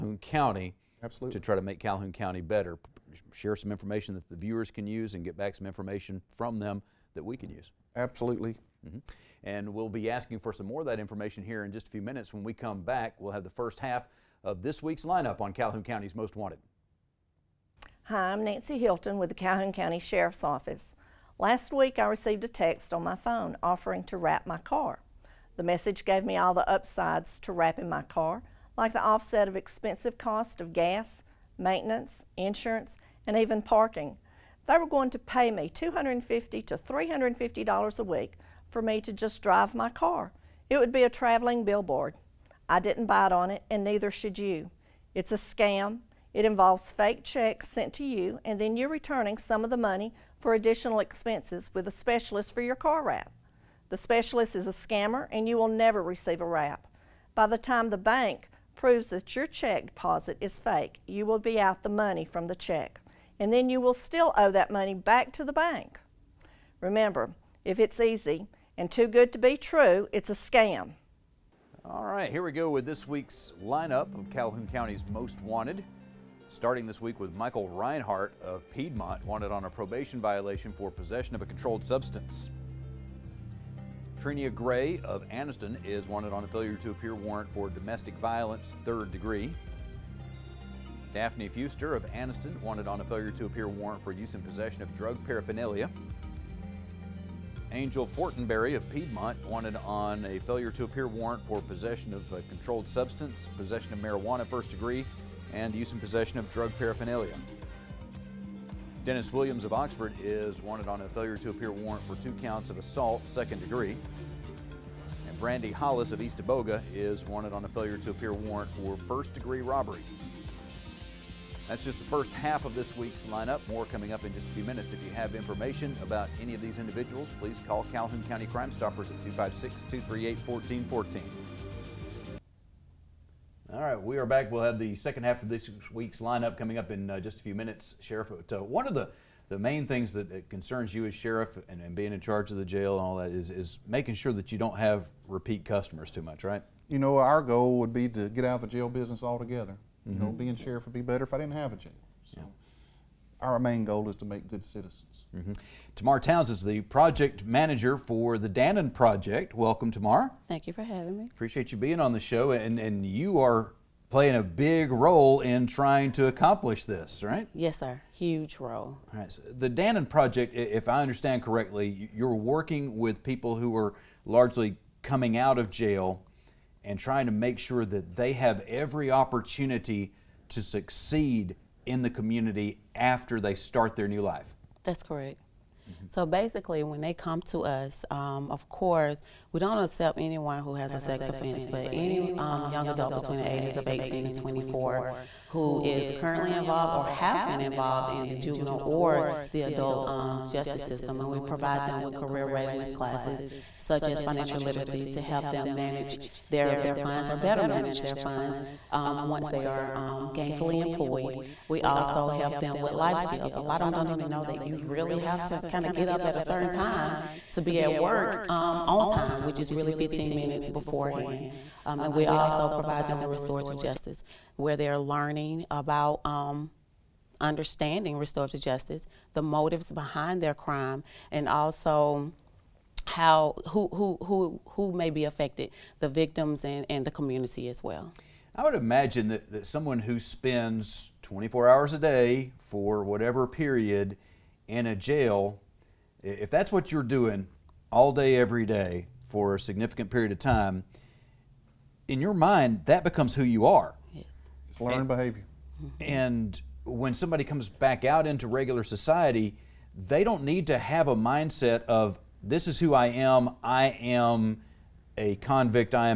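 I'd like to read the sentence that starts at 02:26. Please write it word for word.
You know, our goal would be to get out of the jail business altogether.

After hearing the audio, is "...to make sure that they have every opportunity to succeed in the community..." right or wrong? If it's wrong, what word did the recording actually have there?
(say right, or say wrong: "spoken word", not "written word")
right.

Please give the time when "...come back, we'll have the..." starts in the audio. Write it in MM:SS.
00:12.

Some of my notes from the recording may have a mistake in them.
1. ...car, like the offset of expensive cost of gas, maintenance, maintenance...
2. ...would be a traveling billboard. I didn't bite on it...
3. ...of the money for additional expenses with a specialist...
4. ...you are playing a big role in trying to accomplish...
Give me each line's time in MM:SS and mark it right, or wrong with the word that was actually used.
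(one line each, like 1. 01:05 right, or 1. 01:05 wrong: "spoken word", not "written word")
1. 00:28 wrong: "insurance", not "maintenance"
2. 00:40 right
3. 00:49 right
4. 02:43 right.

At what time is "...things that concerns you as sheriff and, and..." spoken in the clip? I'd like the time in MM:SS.
02:19.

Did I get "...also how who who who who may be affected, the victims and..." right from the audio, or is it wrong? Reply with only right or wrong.
right.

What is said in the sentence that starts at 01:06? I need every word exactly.
Remember, if it's easy, and too good to be true, it's a scam.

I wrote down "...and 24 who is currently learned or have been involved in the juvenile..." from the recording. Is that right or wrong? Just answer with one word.
wrong.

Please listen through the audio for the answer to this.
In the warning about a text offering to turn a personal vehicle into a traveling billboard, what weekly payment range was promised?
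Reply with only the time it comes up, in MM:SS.
00:35.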